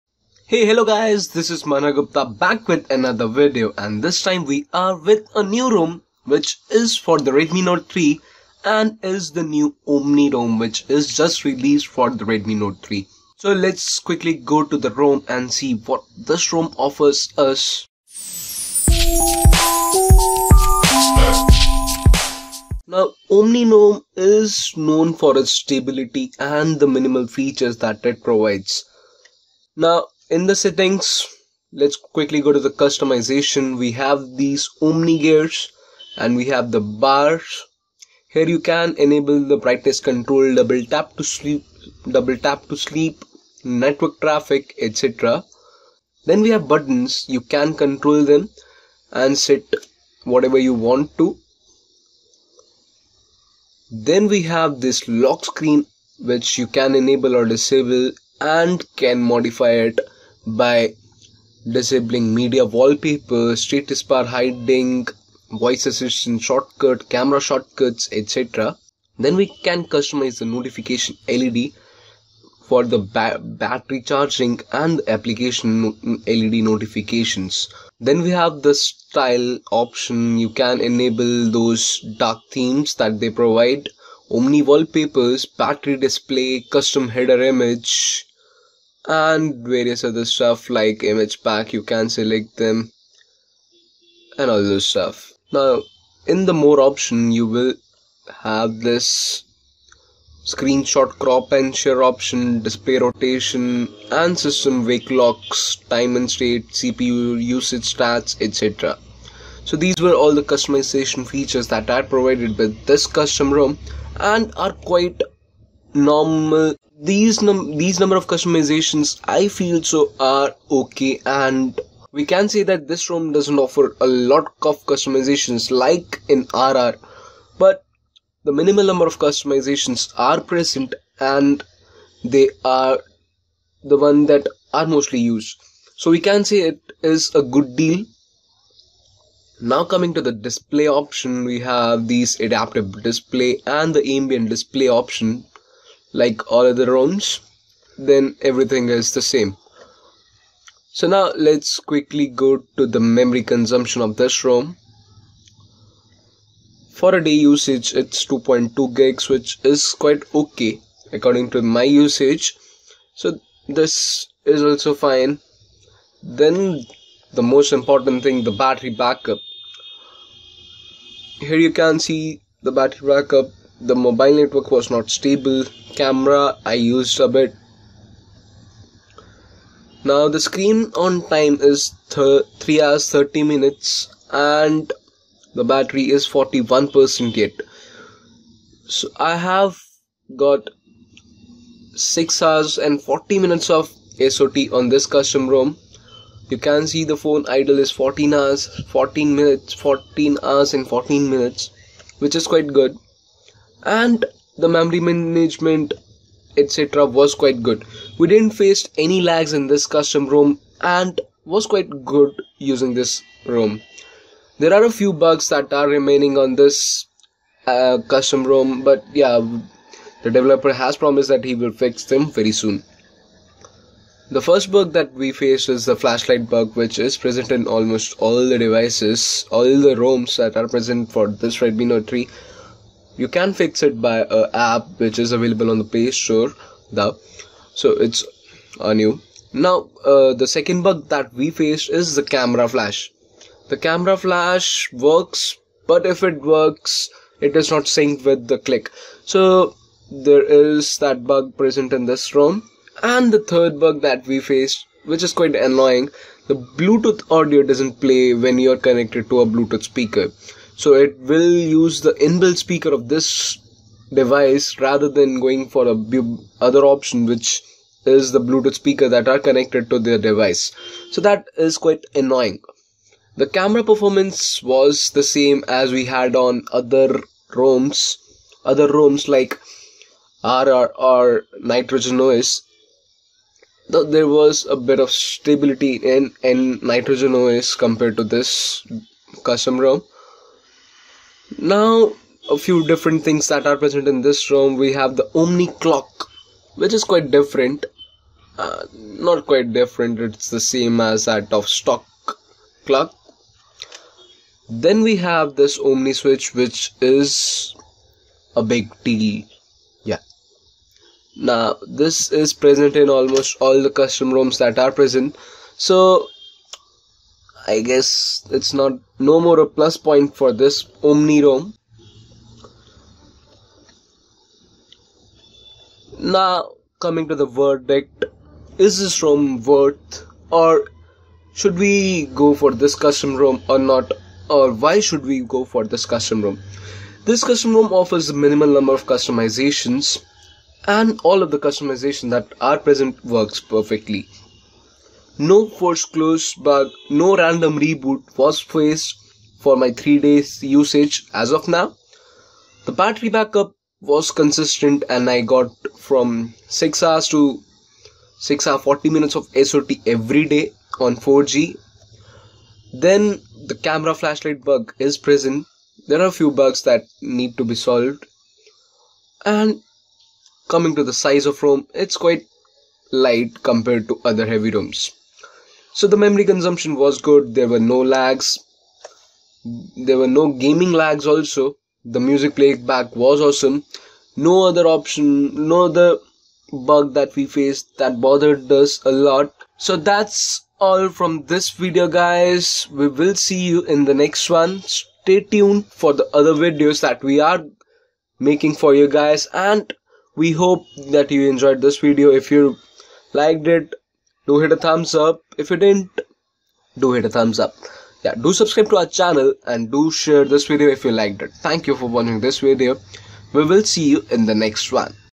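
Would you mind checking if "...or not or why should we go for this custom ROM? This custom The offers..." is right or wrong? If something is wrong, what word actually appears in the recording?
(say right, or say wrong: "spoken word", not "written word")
wrong: "ROM", not "The".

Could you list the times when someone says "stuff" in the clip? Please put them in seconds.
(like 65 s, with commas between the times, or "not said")
90 s, 94 s.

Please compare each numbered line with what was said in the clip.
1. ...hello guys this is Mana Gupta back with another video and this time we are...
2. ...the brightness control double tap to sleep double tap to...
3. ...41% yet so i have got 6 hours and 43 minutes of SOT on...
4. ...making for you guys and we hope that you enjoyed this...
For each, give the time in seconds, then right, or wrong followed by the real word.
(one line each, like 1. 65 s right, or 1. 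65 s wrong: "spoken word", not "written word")
1. 0 s right
2. 39 s right
3. 186 s wrong: "40", not "43"
4. 398 s right.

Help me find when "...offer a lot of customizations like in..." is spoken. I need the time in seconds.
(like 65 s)
123 s.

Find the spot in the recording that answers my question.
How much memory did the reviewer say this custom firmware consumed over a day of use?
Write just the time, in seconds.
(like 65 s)
158 s.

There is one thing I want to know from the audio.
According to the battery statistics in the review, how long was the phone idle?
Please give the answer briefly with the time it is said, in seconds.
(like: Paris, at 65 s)
14 hours 14 minutes, at 198 s.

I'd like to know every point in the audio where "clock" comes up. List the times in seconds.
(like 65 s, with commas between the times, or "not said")
295 s, 302 s.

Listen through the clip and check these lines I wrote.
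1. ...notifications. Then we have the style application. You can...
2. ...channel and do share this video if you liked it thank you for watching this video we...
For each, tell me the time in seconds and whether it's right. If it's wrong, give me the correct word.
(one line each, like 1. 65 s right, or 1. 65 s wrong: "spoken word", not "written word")
1. 76 s wrong: "option", not "application"
2. 409 s right.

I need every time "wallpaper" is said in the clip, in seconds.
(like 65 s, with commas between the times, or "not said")
62 s, 84 s.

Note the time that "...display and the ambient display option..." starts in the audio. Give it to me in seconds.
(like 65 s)
143 s.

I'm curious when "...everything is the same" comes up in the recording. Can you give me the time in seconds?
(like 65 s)
148 s.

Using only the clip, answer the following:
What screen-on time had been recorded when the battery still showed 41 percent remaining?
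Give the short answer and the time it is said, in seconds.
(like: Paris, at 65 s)
3 hours 30 minutes, at 182 s.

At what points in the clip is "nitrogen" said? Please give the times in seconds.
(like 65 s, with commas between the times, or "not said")
281 s, 286 s.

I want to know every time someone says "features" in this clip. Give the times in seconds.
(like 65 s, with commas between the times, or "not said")
27 s, 111 s.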